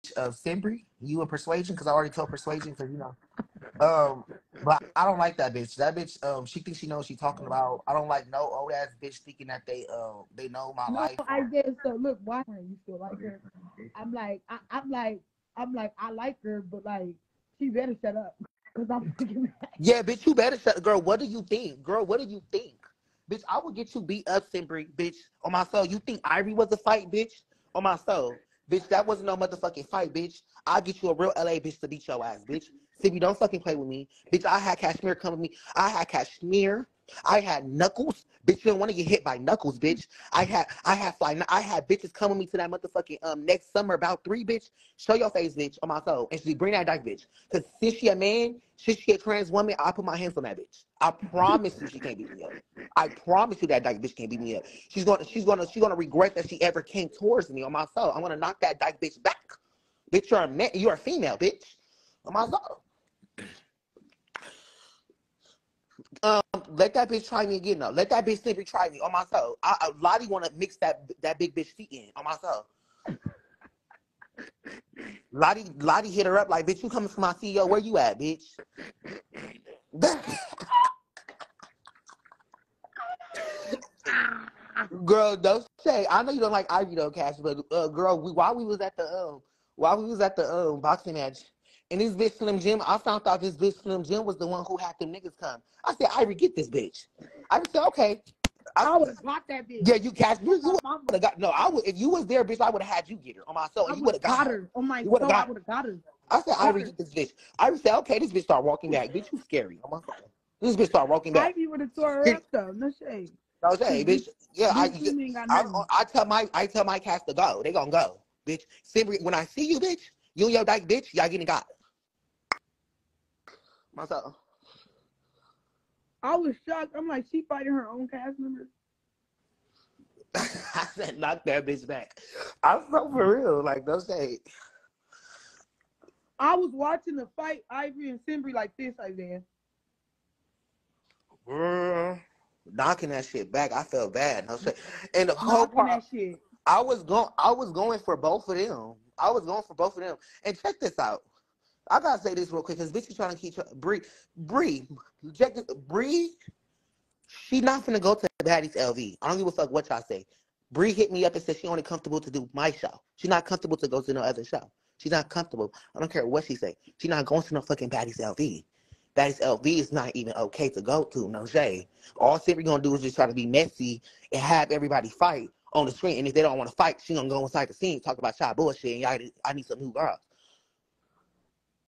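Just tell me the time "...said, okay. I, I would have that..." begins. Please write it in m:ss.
1:37.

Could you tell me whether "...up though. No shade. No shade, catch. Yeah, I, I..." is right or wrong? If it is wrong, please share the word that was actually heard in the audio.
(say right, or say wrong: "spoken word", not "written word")
wrong: "bitch", not "catch".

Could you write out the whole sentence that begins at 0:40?
I had I had fly I had bitches coming me to that motherfucking um next summer about three, bitch.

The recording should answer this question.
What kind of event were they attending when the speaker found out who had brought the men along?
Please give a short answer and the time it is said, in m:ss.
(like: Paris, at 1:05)
Boxing match, at 1:30.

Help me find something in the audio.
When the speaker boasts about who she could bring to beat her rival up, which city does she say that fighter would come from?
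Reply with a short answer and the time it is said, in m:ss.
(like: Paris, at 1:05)
LA, at 0:31.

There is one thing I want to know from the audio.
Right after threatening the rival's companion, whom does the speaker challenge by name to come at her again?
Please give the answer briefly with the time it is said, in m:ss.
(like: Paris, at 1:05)
Snippy, at 1:08.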